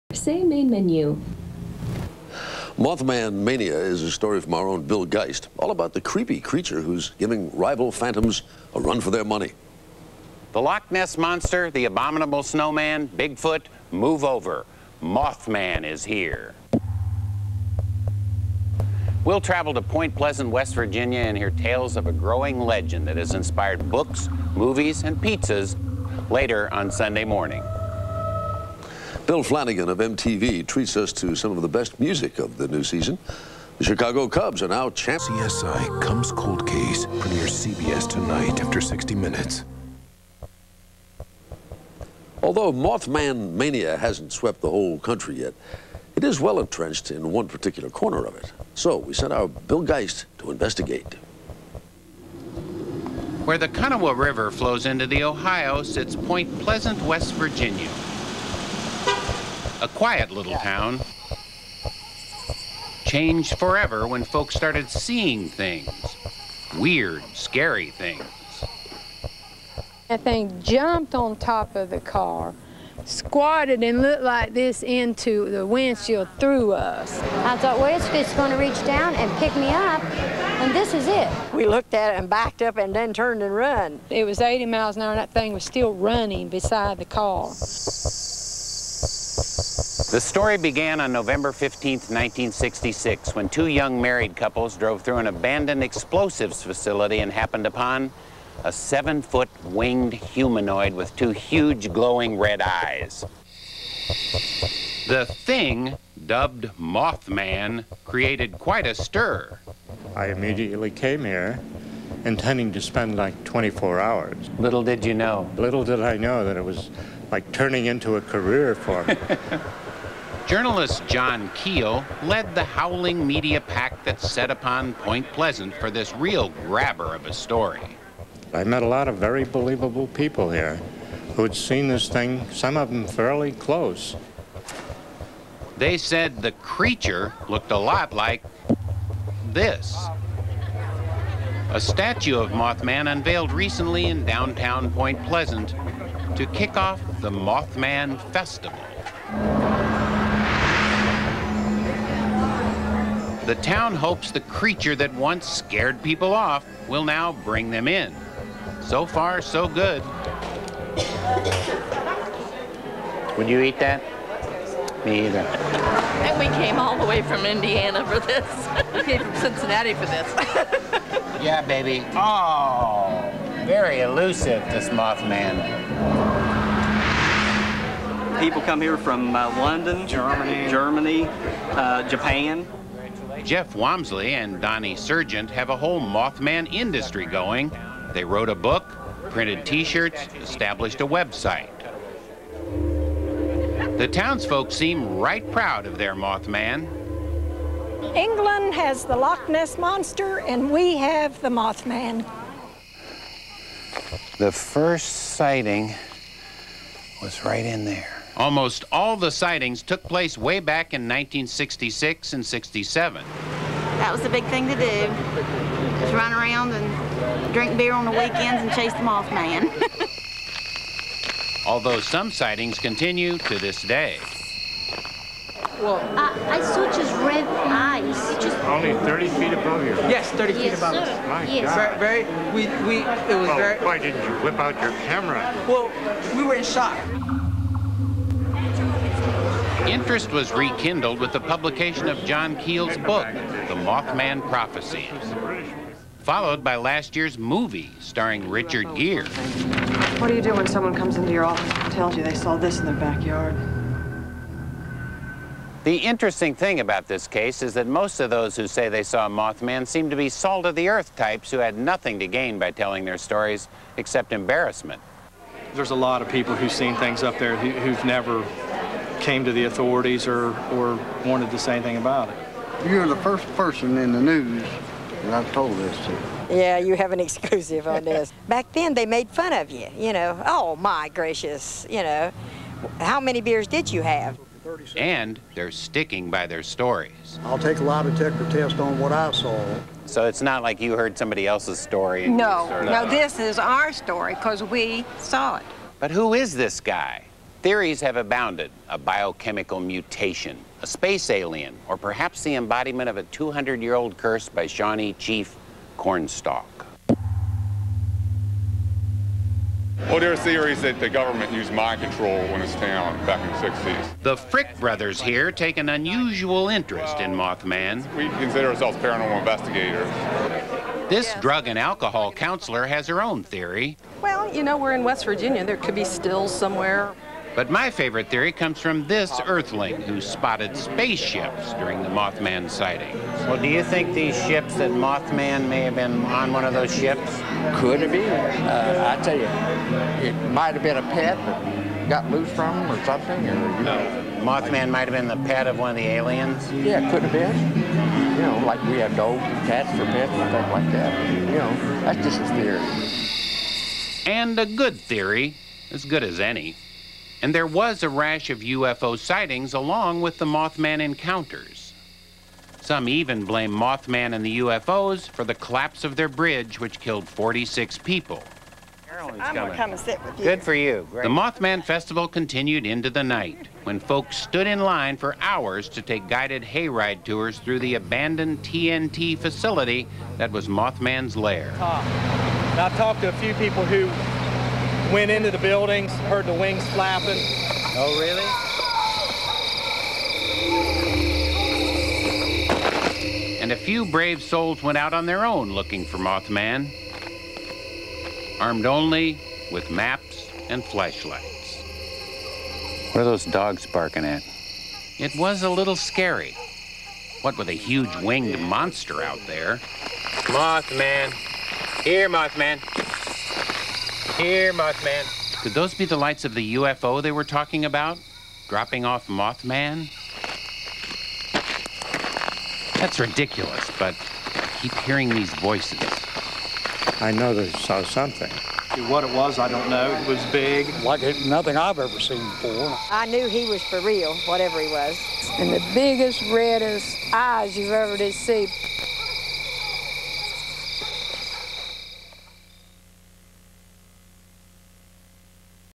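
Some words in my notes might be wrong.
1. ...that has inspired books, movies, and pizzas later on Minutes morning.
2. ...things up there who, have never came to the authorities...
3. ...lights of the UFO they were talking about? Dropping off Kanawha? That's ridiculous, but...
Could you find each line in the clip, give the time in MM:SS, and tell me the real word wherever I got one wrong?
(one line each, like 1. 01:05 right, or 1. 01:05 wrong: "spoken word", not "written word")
1. 00:23 wrong: "Sunday", not "Minutes"
2. 04:26 right
3. 06:56 wrong: "Mothman", not "Kanawha".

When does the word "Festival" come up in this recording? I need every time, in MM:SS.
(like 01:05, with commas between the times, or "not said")
02:28, 06:11.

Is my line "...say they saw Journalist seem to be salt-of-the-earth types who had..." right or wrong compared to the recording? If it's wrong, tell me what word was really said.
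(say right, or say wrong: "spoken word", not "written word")
wrong: "Mothman", not "Journalist".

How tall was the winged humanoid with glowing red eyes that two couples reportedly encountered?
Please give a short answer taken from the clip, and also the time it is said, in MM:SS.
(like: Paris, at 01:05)
Seven-foot, at 01:38.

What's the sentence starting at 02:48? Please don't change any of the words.
we came from Cincinnati for this.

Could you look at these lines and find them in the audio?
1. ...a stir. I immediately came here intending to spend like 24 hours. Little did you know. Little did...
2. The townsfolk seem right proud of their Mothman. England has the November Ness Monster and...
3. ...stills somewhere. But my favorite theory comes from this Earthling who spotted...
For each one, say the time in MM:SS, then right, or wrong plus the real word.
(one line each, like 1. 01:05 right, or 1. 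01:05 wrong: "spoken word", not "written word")
1. 01:48 right
2. 03:13 wrong: "Loch", not "November"
3. 05:26 right.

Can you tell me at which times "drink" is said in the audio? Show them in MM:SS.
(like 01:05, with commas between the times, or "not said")
03:37.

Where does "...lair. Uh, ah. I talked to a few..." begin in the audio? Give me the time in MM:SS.
06:21.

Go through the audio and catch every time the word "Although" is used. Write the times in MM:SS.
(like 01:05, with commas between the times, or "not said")
00:42, 03:41.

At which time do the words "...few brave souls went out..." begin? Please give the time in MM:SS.
06:33.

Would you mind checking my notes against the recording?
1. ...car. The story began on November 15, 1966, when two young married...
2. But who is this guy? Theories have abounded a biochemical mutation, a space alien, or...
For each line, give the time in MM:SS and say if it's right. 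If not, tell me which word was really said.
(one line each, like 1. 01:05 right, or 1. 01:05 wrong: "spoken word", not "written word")
1. 01:27 right
2. 04:55 right.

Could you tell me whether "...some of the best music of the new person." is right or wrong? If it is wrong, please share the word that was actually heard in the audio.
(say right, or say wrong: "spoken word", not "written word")
wrong: "season", not "person".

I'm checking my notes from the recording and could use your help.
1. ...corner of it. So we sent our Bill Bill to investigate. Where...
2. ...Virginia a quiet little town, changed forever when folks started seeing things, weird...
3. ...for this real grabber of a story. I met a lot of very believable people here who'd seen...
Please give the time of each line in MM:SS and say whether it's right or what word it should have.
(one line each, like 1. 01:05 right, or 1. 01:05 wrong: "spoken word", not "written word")
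1. 00:47 wrong: "Geist", not "Bill"
2. 00:57 right
3. 02:05 right.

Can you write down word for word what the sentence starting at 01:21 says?
We looked at it and backed up and then turned and run.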